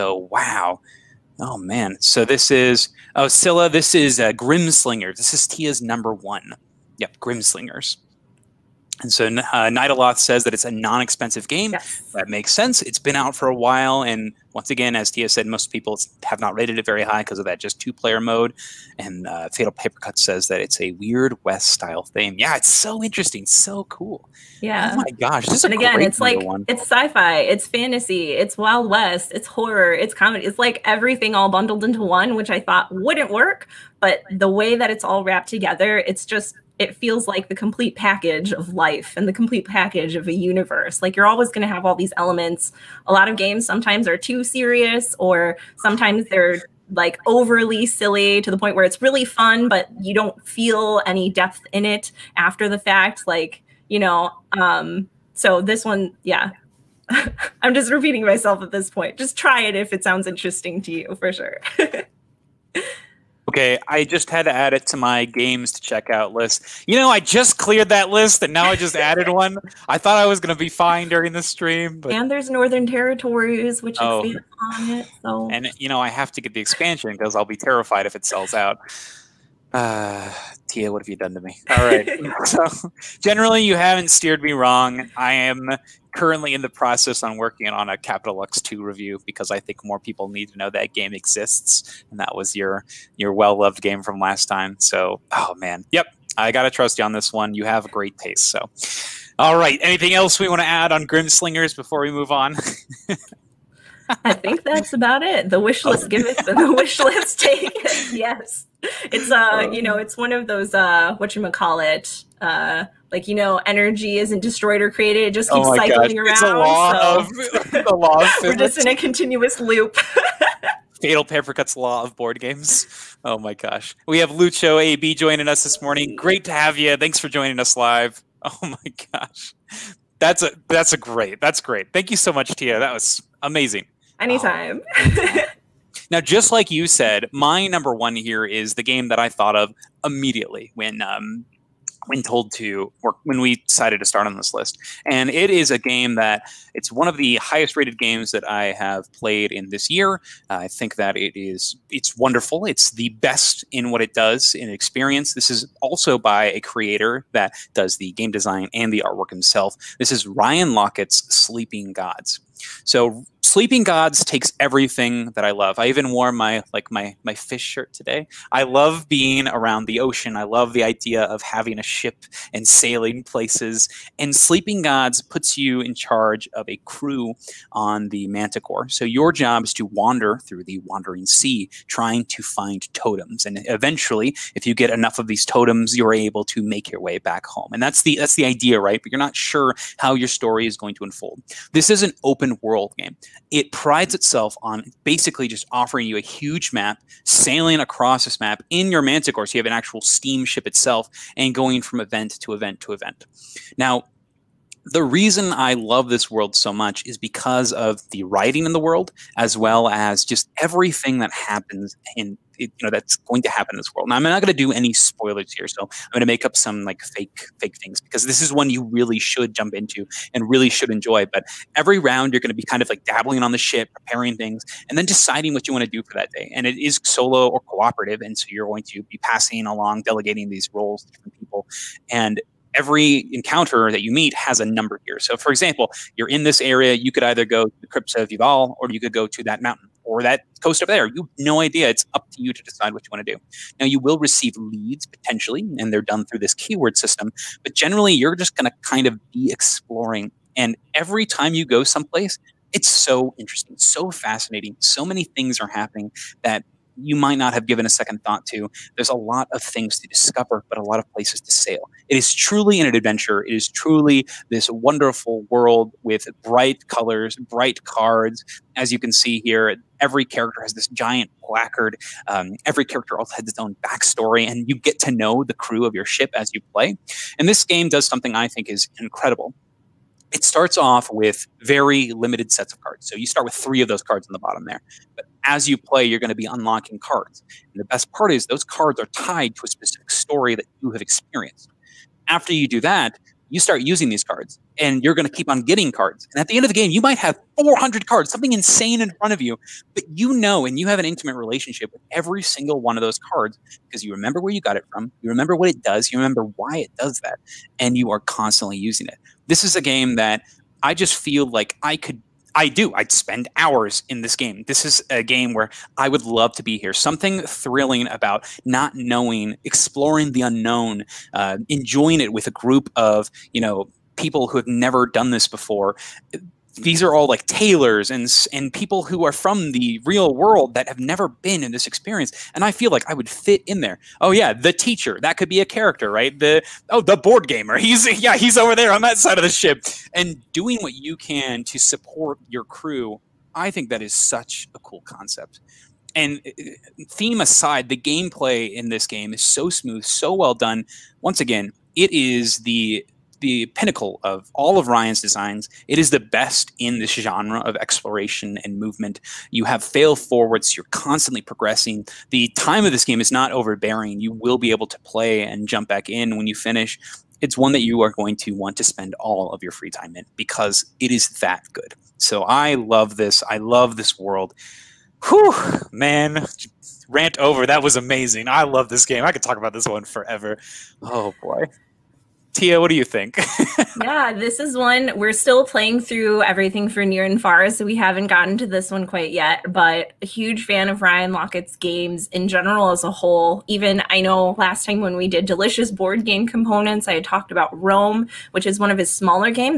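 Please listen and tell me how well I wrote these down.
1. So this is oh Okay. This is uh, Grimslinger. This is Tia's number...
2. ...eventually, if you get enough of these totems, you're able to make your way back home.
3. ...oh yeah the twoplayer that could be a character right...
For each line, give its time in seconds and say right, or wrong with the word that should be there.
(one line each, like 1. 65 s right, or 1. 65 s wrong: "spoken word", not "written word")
1. 1 s wrong: "Scylla", not "Okay"
2. 183 s right
3. 334 s wrong: "teacher", not "twoplayer".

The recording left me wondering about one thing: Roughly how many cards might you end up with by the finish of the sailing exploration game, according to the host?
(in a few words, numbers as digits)
400.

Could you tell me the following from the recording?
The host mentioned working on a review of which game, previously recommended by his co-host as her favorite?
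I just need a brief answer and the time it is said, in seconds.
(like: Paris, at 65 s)
Capital Lux 2, at 87 s.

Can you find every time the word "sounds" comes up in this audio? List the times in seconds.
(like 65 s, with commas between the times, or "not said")
60 s.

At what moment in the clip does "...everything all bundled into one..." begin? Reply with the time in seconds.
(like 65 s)
30 s.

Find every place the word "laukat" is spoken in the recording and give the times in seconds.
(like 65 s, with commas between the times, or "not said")
160 s, 391 s.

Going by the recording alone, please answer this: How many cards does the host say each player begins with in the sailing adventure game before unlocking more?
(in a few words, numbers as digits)
3.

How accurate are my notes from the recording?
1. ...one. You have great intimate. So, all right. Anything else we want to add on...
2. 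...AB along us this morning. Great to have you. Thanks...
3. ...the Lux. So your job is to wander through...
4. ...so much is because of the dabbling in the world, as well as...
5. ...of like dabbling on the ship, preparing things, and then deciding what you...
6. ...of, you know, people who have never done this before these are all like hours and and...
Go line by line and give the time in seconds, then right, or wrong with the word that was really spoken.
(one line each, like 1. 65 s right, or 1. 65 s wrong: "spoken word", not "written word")
1. 97 s wrong: "taste", not "intimate"
2. 124 s wrong: "joining", not "along"
3. 178 s wrong: "Manticore", not "Lux"
4. 206 s wrong: "writing", not "dabbling"
5. 222 s right
6. 322 s wrong: "tailors", not "hours".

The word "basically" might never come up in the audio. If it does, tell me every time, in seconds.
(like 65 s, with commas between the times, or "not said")
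195 s.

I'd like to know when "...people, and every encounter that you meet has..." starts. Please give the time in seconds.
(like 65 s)
231 s.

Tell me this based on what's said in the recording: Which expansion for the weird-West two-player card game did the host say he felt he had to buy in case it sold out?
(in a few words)
Northern Territories.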